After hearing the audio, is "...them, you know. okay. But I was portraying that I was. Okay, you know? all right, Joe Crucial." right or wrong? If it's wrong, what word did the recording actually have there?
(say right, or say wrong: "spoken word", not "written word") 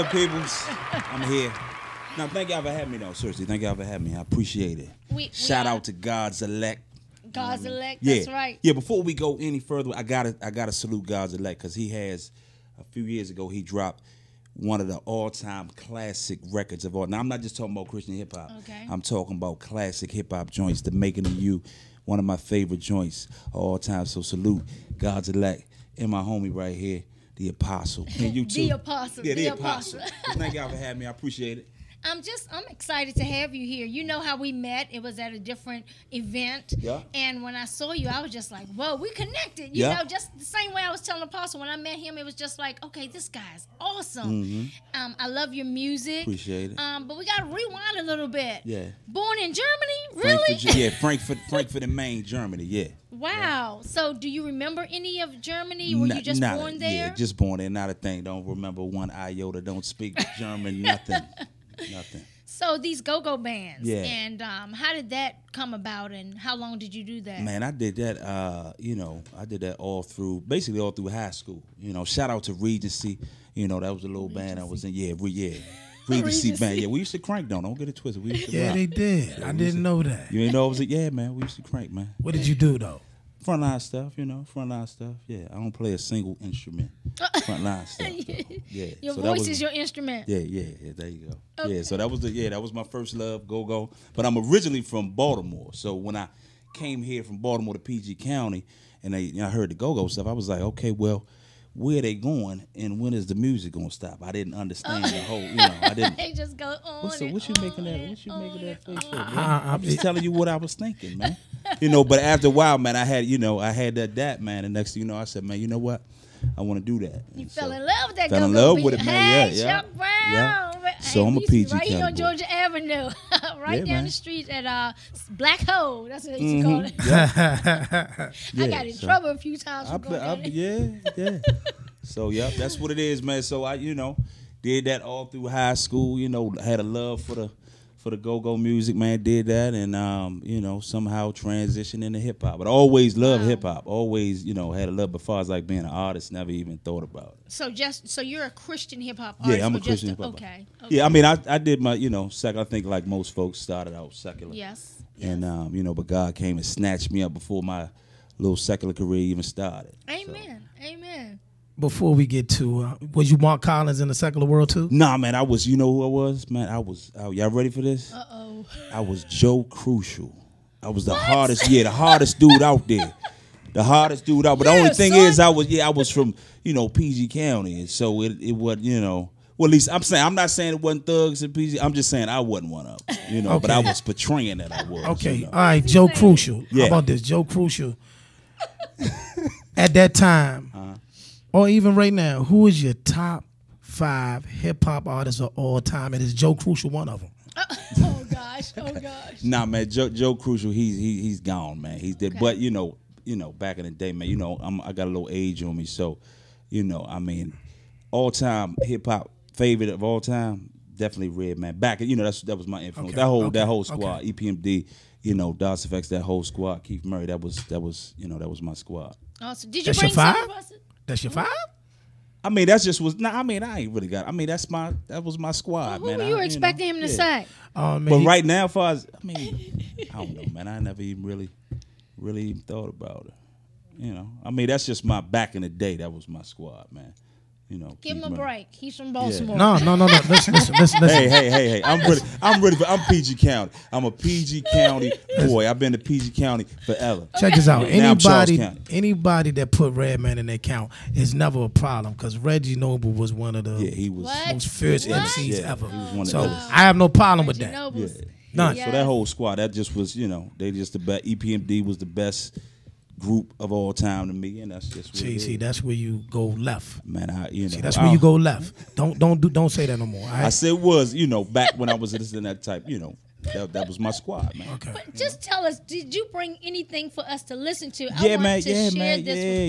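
right.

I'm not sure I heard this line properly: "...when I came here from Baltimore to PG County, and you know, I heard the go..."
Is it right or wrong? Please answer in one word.
right.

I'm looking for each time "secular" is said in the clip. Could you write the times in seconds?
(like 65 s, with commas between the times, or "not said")
154 s, 158 s, 164 s.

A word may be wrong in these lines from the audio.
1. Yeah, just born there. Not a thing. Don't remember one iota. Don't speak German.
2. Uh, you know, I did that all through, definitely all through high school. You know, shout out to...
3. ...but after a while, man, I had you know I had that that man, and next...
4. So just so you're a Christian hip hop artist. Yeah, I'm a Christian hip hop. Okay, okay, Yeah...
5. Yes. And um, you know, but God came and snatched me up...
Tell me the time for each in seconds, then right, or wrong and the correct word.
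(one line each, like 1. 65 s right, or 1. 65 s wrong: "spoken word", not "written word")
1. 56 s right
2. 68 s wrong: "basically", not "definitely"
3. 112 s right
4. 147 s right
5. 154 s right.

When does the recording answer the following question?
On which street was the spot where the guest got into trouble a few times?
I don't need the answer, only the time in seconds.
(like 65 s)
122 s.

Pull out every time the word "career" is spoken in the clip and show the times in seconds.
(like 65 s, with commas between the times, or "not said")
158 s.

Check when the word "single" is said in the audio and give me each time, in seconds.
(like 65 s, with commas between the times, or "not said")
85 s.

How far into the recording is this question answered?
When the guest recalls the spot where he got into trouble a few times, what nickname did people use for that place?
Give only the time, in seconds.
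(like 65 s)
125 s.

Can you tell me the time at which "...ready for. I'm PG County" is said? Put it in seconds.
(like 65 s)
242 s.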